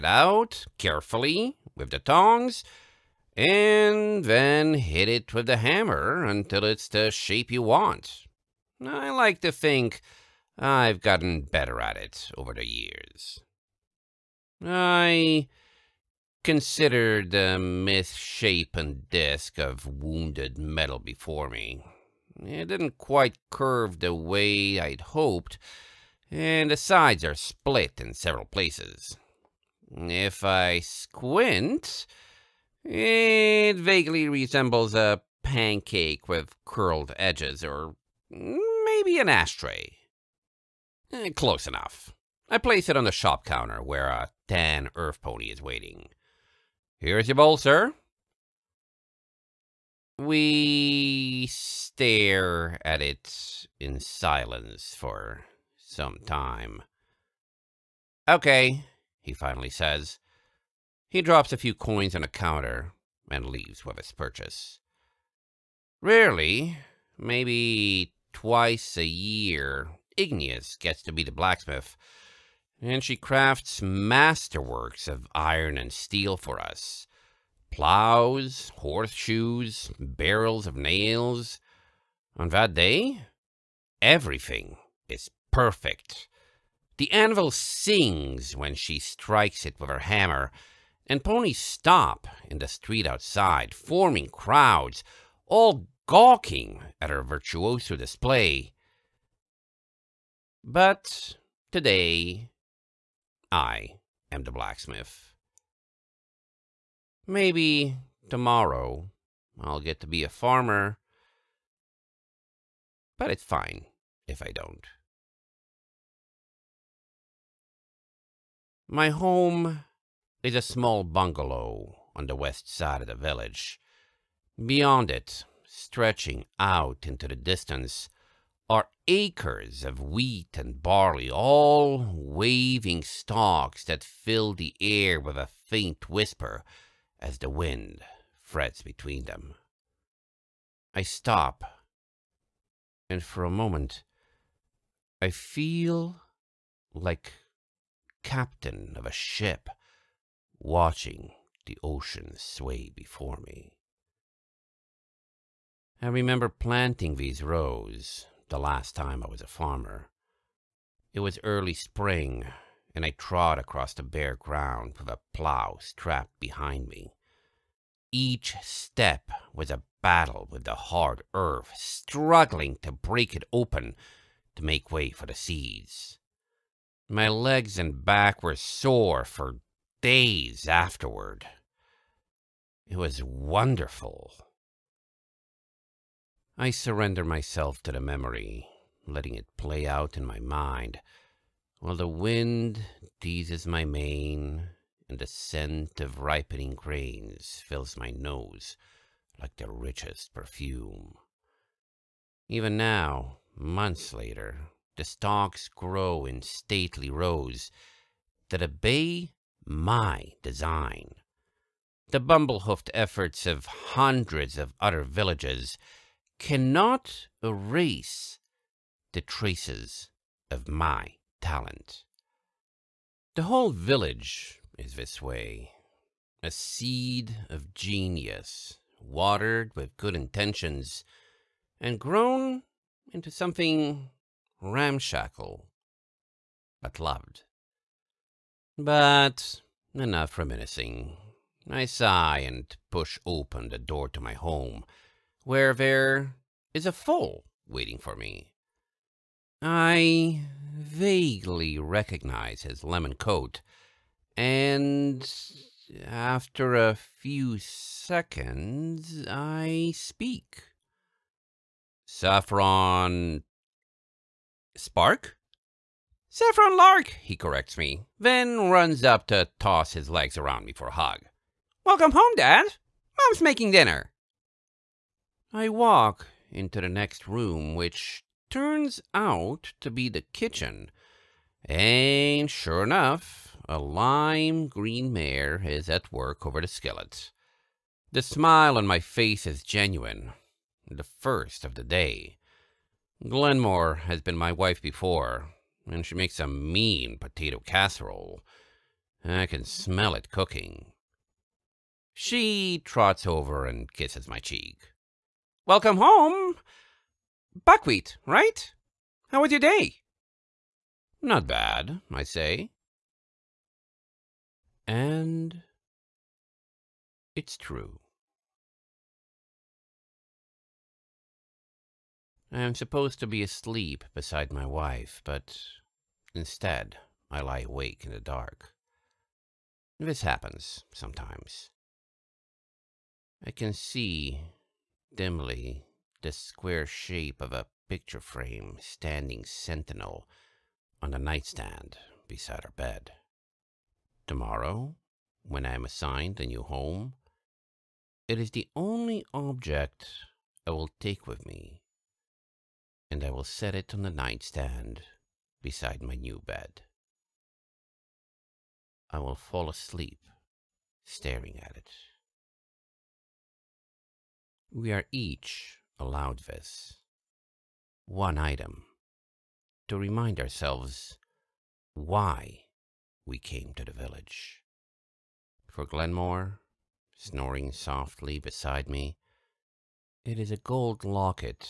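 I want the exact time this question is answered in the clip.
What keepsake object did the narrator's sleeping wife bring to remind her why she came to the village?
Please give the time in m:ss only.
6:20.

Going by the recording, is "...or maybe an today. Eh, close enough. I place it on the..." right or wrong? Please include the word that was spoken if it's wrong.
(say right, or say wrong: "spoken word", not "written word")
wrong: "ashtray", not "today".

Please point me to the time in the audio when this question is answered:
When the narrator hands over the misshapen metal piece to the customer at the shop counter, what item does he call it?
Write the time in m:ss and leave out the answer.
0:47.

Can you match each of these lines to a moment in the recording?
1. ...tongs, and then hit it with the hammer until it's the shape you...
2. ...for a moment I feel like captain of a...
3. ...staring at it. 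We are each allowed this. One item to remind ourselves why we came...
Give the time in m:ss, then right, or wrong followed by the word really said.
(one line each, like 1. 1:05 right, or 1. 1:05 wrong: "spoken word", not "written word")
1. 0:01 right
2. 2:23 right
3. 6:01 right.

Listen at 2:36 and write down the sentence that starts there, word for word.
I remember planting these rows the last time I was a farmer.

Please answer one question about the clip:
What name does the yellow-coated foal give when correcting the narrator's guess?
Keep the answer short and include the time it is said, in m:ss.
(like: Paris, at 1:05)
Saffron Lark, at 4:26.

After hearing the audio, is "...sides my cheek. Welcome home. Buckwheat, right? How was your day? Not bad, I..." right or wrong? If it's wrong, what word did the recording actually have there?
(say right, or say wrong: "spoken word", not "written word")
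wrong: "kisses", not "sides".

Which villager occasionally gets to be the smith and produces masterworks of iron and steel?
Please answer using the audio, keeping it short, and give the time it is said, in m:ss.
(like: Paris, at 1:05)
Igneous, at 1:10.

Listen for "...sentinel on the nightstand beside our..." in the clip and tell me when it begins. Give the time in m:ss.
5:39.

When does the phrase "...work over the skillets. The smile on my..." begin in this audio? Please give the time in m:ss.
4:46.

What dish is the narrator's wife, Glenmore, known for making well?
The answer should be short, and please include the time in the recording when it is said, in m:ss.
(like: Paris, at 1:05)
potato casserole, at 4:57.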